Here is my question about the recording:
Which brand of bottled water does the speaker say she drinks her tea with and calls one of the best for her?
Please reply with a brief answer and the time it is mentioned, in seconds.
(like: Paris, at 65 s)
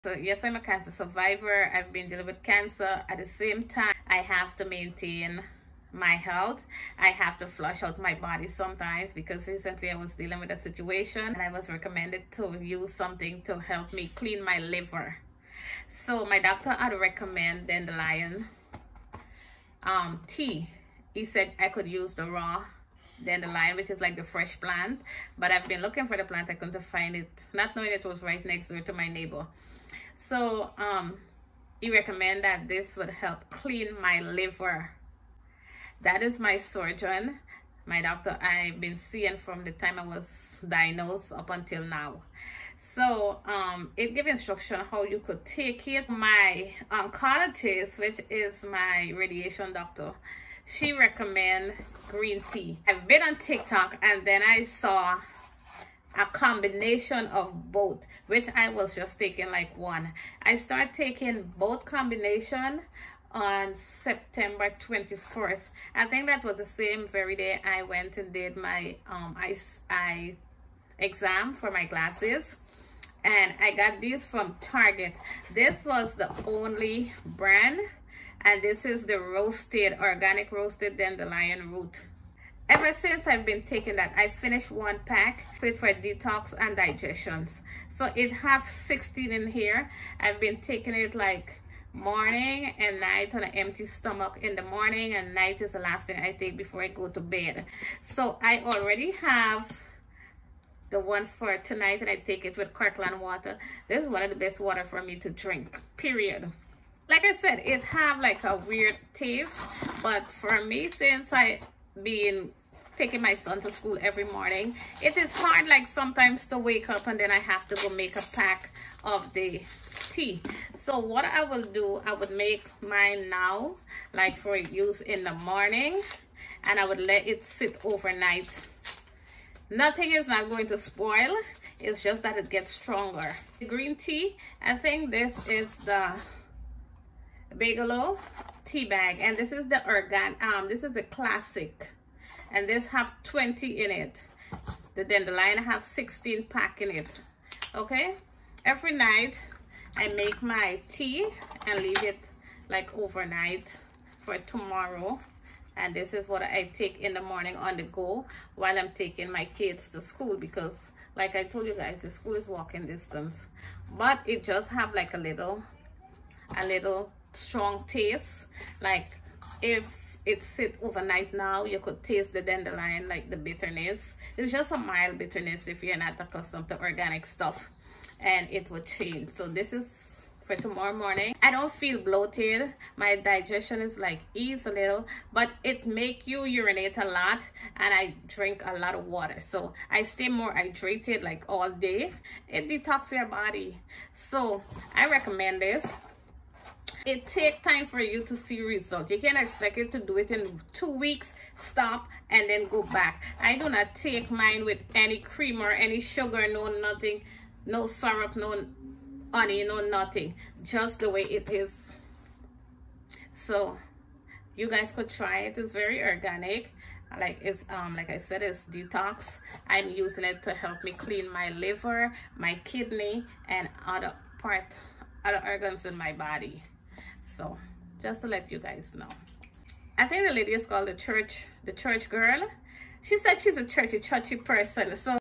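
Kirkland, at 102 s.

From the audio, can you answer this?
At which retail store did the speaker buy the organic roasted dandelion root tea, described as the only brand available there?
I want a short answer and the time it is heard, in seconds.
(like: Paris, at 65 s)
Target, at 74 s.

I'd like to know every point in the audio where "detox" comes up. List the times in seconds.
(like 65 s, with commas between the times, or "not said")
85 s, 192 s, 218 s.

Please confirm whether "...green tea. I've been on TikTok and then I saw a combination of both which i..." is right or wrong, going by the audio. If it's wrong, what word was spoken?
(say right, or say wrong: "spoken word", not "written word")
right.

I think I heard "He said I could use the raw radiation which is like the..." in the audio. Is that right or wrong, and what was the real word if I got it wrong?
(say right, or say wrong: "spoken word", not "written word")
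wrong: "dandelion", not "radiation".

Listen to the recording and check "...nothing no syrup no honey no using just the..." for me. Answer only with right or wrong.
wrong.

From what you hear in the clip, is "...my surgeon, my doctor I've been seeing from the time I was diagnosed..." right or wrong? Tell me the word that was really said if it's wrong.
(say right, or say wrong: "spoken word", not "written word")
right.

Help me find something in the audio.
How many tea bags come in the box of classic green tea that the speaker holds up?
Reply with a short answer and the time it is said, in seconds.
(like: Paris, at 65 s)
20, at 143 s.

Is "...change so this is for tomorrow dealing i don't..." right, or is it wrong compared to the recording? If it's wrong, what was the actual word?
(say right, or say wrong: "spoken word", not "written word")
wrong: "morning", not "dealing".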